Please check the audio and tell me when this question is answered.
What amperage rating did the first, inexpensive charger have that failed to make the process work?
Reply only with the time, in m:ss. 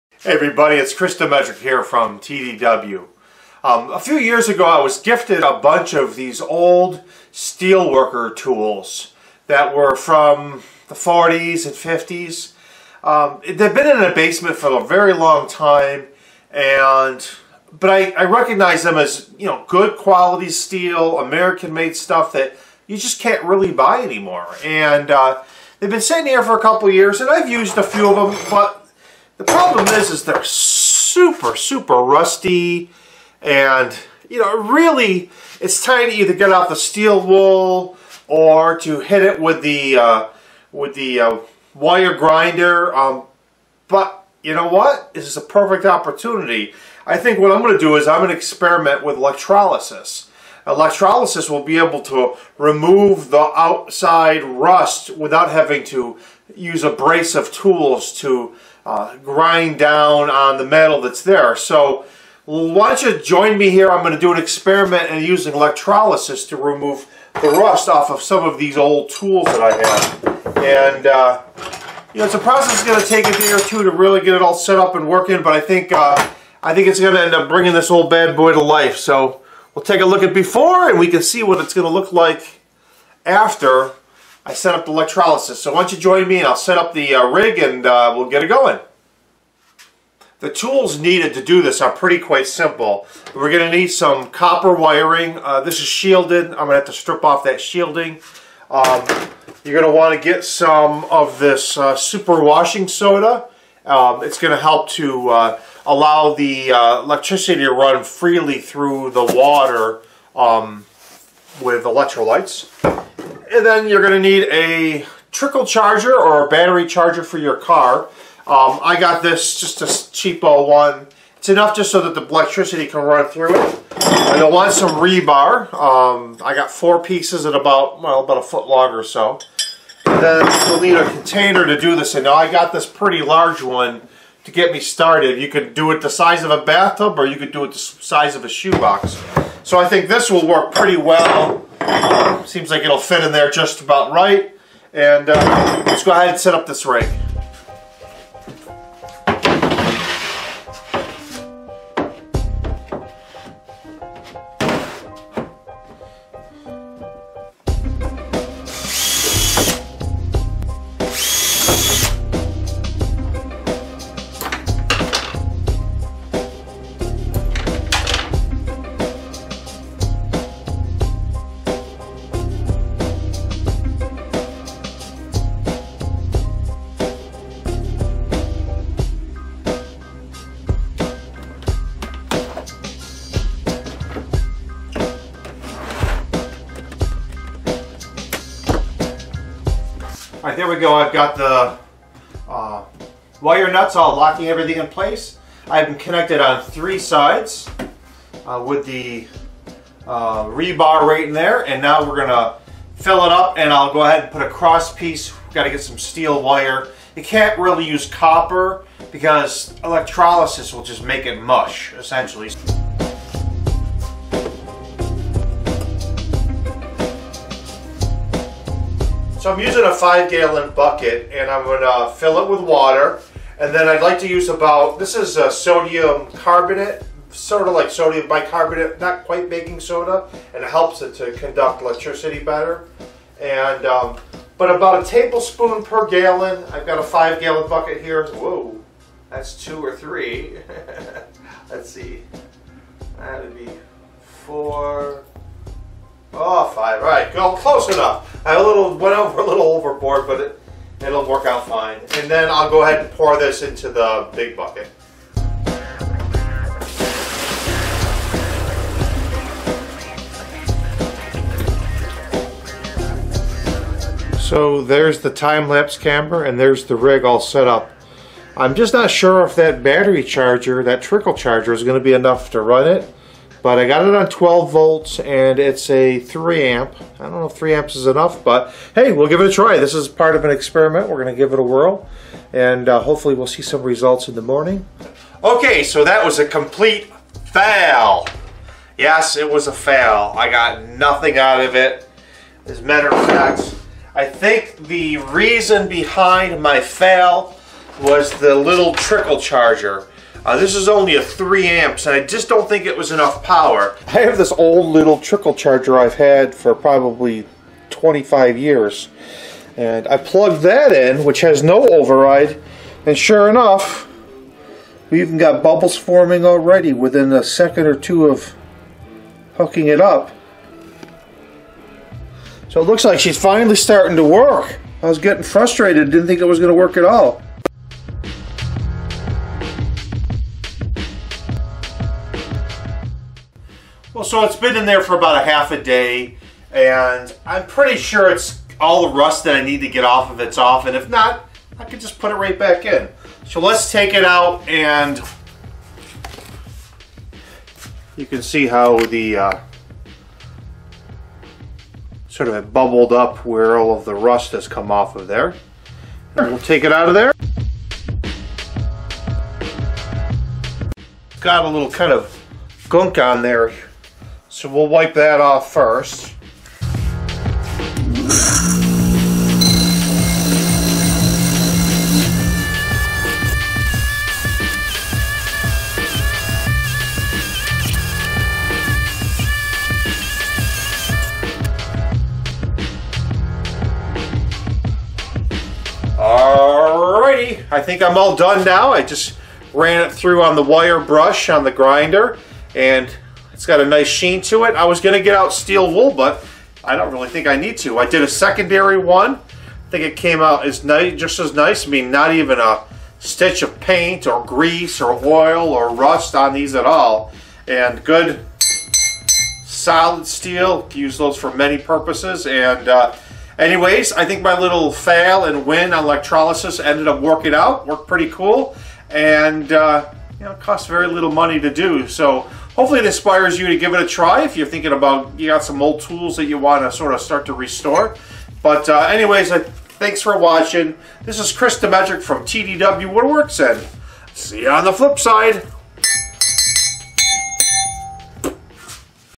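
4:36.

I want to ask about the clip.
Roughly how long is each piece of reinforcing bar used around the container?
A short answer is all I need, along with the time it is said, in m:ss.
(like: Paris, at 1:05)
about a foot, at 2:08.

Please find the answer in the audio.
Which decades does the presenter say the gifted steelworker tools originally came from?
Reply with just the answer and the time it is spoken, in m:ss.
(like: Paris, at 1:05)
40s and 50s, at 0:10.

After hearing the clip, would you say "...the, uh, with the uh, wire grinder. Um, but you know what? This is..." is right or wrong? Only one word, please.
right.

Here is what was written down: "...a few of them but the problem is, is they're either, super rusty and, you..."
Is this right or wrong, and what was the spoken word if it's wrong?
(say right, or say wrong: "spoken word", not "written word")
wrong: "super", not "either".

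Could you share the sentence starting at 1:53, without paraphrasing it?
And then you're going to need a trickle charger or a battery charger for your car.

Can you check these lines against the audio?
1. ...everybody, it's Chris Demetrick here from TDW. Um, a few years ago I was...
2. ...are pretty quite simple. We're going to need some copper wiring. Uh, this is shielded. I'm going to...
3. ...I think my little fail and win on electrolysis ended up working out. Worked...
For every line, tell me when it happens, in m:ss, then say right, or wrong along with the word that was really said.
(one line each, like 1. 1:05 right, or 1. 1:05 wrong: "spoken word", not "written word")
1. 0:00 right
2. 1:31 right
3. 6:54 right.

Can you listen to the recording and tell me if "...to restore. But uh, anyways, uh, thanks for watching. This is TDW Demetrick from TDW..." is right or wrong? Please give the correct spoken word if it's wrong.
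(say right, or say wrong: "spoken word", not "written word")
wrong: "Chris", not "TDW".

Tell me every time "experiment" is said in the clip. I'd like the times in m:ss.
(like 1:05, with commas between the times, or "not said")
0:48, 1:04, 4:40.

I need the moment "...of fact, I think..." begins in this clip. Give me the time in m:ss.
4:53.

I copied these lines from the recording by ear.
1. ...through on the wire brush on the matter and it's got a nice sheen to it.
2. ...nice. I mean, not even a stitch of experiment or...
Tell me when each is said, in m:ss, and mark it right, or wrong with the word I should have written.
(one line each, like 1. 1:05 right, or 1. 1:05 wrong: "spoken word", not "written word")
1. 6:30 wrong: "grinder", not "matter"
2. 6:41 wrong: "paint", not "experiment".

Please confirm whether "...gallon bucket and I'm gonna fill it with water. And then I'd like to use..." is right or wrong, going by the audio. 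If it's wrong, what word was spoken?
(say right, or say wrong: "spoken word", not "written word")
right.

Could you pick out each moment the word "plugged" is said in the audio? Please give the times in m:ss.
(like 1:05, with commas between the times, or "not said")
5:10.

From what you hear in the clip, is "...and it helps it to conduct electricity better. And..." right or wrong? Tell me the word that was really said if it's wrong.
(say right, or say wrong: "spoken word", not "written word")
right.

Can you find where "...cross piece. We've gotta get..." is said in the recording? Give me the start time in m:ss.
3:24.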